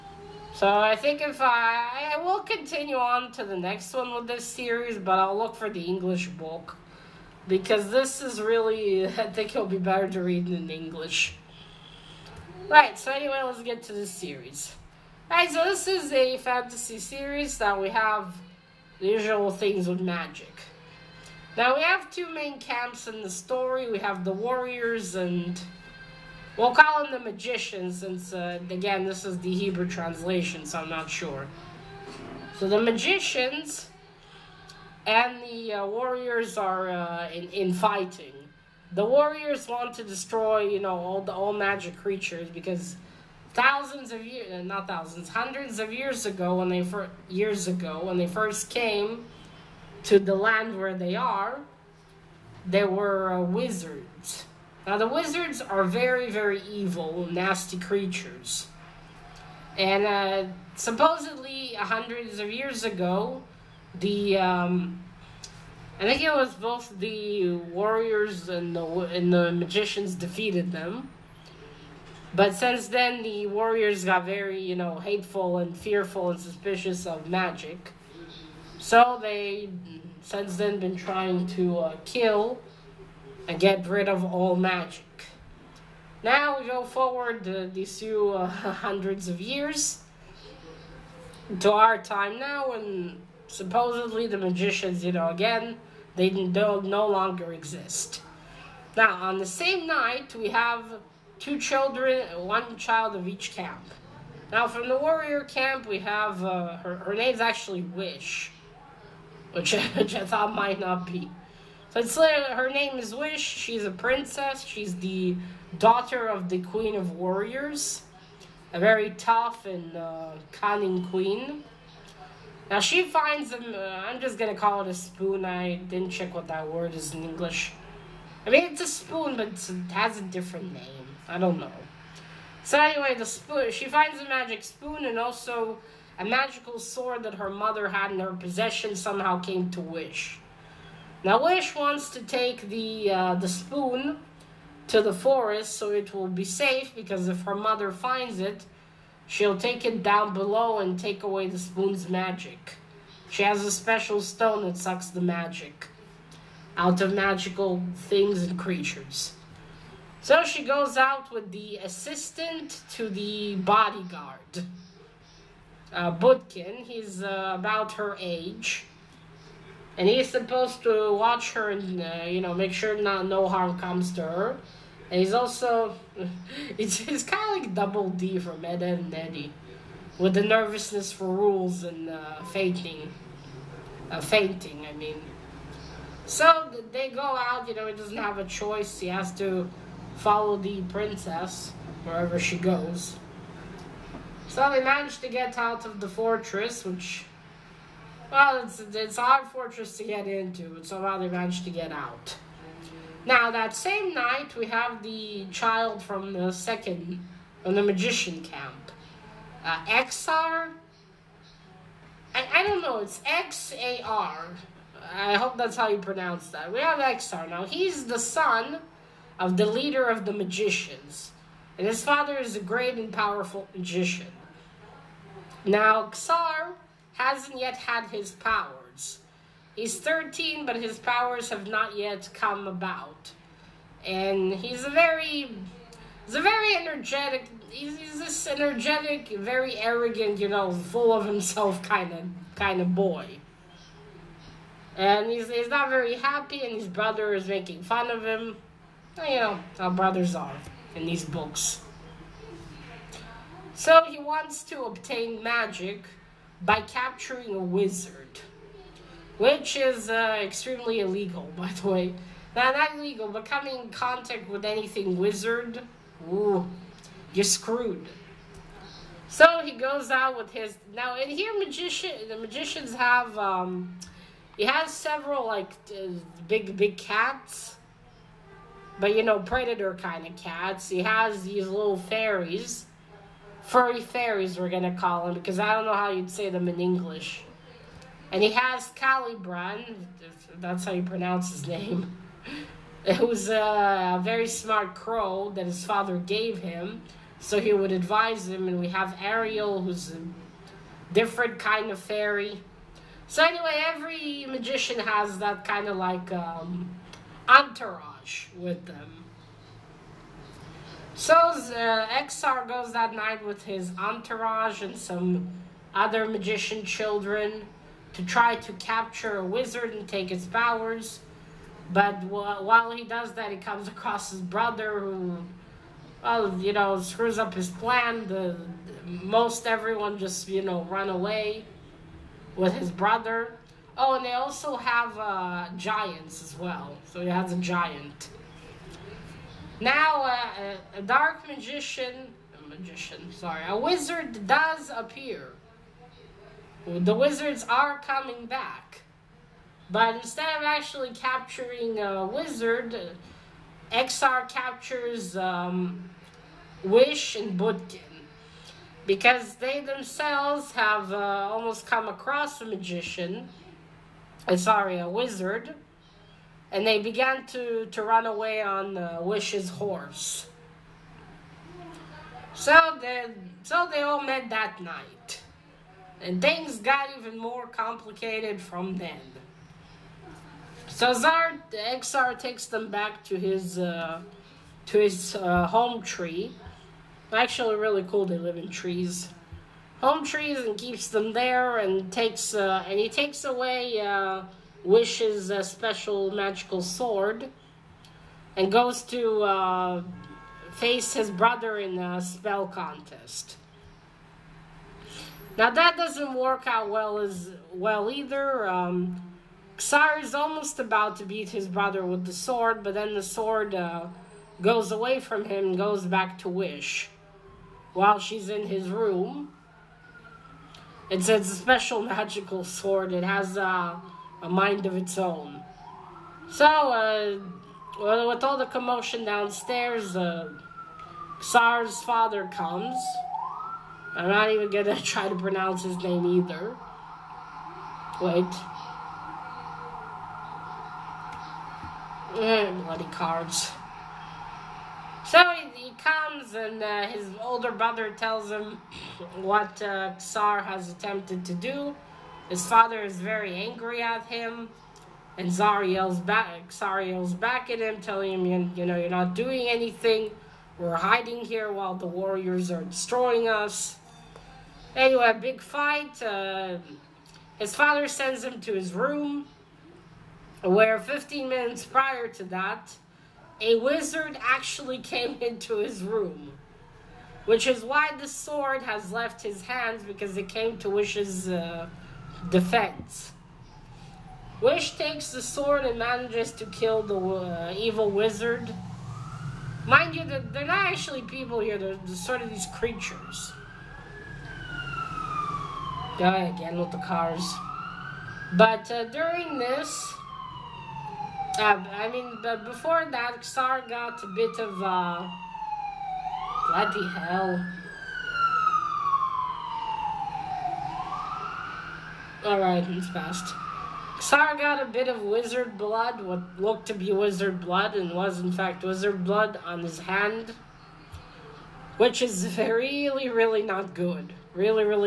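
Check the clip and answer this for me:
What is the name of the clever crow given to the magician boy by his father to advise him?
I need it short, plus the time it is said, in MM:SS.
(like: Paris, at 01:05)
Calibran, at 04:48.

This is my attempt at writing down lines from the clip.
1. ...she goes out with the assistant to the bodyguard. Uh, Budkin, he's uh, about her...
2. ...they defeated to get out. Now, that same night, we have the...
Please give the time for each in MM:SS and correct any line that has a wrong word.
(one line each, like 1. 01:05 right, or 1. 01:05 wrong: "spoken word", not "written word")
1. 02:40 right
2. 03:21 wrong: "managed", not "defeated".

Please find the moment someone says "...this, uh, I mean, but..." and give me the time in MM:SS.
08:19.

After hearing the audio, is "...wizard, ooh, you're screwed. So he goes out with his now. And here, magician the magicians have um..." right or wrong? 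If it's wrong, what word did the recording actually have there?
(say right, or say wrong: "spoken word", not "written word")
right.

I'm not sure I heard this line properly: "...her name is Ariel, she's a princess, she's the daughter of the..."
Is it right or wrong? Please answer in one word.
wrong.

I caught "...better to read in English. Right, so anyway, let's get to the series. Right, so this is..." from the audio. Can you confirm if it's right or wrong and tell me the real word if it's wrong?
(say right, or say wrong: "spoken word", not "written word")
right.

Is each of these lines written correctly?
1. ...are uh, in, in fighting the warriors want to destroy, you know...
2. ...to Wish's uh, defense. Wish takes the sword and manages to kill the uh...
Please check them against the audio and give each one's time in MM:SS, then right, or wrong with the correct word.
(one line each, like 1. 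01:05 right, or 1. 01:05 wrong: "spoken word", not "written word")
1. 00:36 right
2. 08:00 right.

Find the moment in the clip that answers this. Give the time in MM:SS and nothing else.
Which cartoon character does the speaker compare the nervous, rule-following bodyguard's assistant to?
02:57.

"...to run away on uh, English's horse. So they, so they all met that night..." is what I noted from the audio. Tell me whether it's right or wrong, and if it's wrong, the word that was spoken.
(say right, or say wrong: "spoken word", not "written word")
wrong: "Wish", not "English".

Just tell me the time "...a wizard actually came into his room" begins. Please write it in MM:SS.
07:53.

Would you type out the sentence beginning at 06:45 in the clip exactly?
Now that doesn't work out well as well either.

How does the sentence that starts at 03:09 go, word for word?
He has to follow the princess wherever she goes.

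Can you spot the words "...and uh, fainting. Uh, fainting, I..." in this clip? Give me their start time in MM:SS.
03:01.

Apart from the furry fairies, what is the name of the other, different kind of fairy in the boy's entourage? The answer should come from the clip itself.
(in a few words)
Ariel.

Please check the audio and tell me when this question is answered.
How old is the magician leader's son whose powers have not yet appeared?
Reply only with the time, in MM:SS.
03:49.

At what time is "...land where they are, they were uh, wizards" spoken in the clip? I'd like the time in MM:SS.
00:50.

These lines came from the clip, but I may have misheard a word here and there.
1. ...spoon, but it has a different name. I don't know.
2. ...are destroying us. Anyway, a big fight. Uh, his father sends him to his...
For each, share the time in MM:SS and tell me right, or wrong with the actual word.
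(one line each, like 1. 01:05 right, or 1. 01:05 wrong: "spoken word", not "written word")
1. 02:08 right
2. 07:42 right.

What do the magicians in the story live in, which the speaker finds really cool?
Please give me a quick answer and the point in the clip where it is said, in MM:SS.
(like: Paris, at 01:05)
Home trees, at 06:30.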